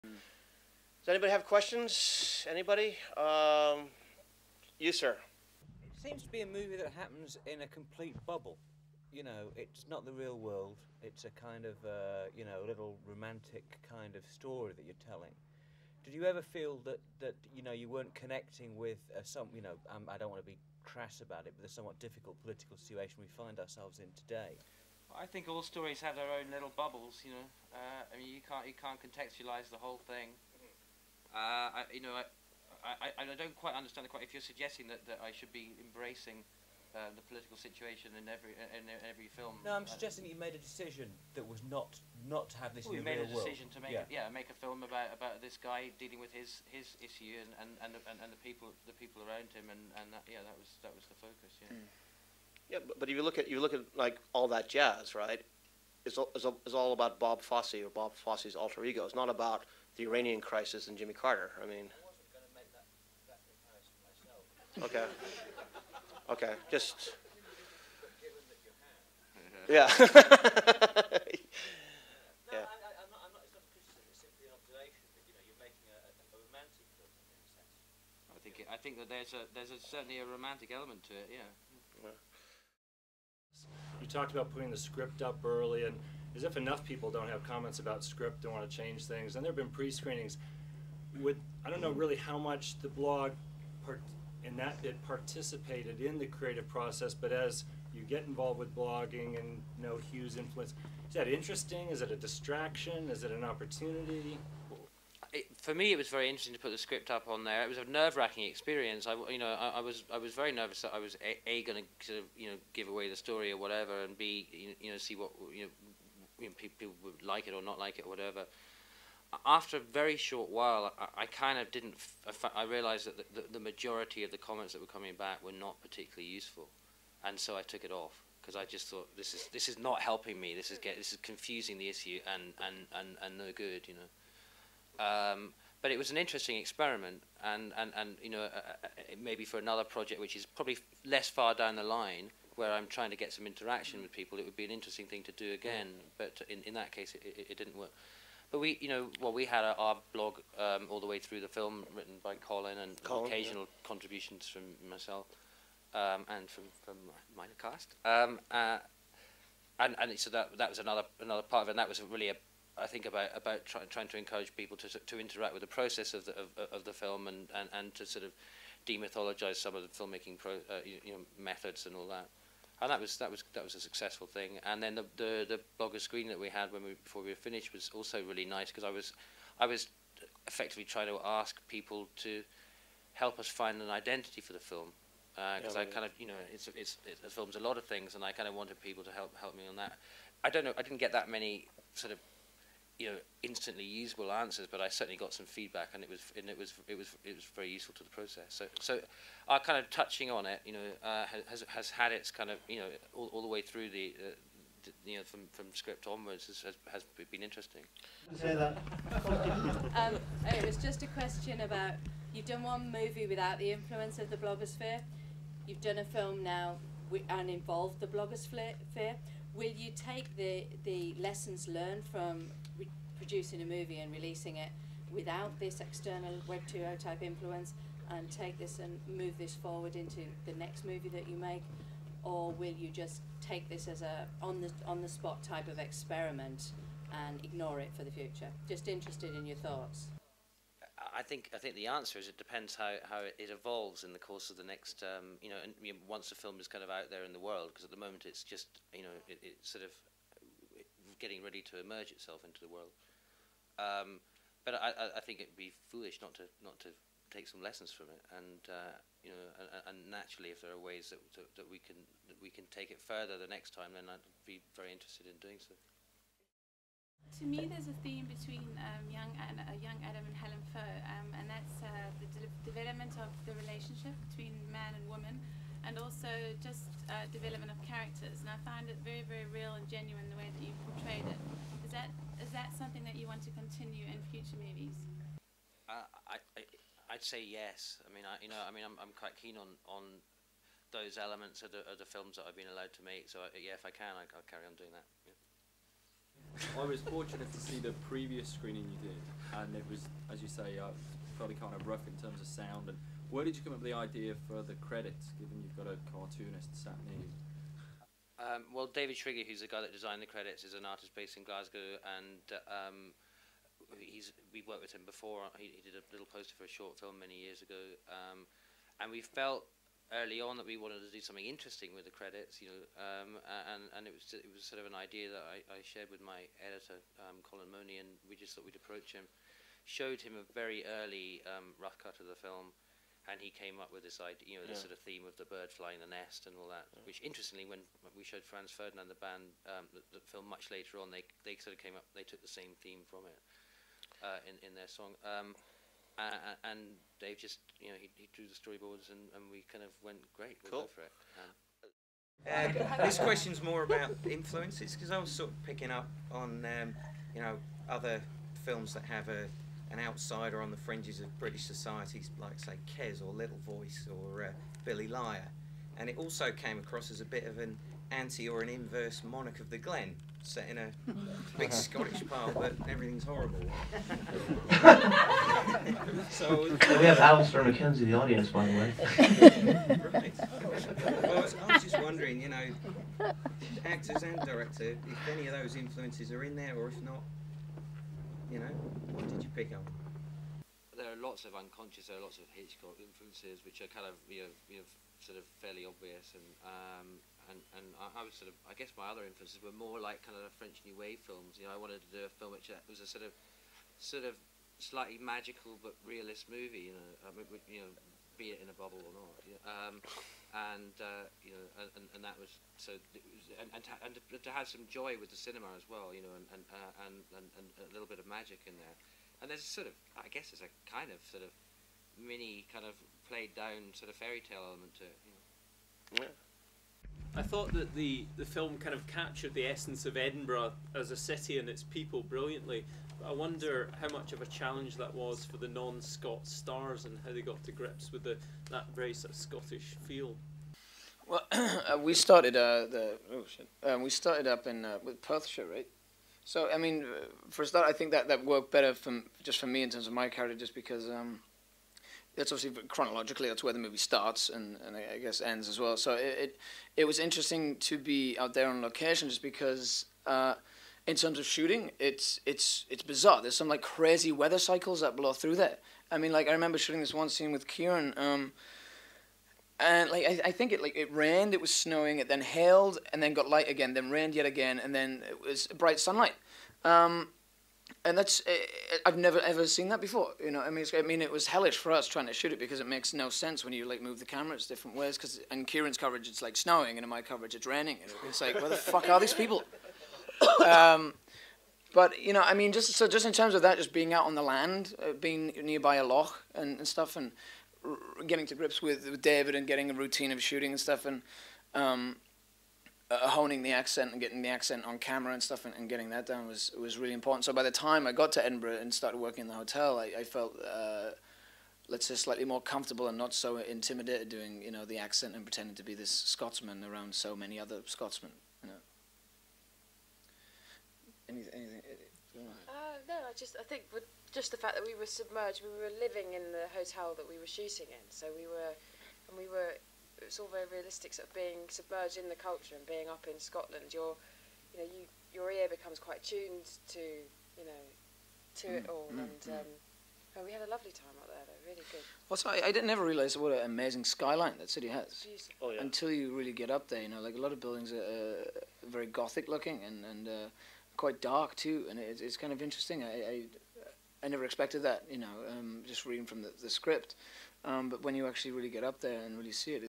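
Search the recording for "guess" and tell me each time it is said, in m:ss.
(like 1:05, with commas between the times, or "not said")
6:38, 7:00, 7:35.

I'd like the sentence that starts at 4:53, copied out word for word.
So I, yeah, if I can, I, will carry on doing that.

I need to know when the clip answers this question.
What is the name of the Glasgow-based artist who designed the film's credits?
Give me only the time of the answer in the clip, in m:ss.
5:08.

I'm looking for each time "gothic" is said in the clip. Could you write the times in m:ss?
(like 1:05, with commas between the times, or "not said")
9:09.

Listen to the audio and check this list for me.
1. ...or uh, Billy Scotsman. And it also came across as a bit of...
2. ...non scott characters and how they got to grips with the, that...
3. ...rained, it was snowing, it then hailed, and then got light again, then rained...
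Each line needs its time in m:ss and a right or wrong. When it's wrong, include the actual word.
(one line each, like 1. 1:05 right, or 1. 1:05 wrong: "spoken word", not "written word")
1. 6:04 wrong: "Liar", not "Scotsman"
2. 7:15 wrong: "stars", not "characters"
3. 7:51 right.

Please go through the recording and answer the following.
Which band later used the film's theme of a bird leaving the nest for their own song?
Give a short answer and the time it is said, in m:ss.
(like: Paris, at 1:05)
Franz Ferdinand, at 5:38.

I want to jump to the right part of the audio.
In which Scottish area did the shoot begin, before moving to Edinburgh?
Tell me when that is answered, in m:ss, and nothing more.
7:25.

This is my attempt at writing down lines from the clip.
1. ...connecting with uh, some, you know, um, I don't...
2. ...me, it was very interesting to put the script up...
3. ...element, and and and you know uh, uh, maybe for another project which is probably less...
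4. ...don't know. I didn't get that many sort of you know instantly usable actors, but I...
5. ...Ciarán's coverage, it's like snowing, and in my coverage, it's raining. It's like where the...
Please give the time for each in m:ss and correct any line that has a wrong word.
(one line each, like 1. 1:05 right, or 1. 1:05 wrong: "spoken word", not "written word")
1. 0:18 right
2. 1:45 right
3. 2:16 wrong: "experiment", not "element"
4. 3:10 wrong: "answers", not "actors"
5. 8:05 right.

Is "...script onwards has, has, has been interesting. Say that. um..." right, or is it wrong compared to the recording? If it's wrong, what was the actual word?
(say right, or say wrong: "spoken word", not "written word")
right.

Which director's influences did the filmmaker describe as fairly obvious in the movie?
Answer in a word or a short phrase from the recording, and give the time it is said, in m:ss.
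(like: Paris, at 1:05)
Hitchcock, at 6:32.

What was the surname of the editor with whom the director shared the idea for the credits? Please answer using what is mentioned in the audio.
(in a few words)
Monie.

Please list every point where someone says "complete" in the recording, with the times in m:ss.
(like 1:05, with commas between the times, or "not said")
0:07.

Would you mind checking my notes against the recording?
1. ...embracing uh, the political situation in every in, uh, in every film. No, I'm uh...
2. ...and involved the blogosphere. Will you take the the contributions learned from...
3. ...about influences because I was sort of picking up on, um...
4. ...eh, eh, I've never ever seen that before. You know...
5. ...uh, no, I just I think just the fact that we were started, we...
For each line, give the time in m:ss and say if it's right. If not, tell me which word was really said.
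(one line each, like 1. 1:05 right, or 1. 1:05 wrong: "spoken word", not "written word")
1. 0:35 right
2. 3:37 wrong: "lessons", not "contributions"
3. 5:53 right
4. 7:58 right
5. 8:42 wrong: "submerged", not "started".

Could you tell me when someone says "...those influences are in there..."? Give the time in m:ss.
6:25.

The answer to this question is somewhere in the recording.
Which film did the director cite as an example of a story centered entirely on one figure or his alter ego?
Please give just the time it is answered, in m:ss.
0:54.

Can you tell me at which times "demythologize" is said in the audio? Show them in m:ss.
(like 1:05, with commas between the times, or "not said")
2:48.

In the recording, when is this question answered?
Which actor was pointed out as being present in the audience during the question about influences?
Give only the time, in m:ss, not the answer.
6:17.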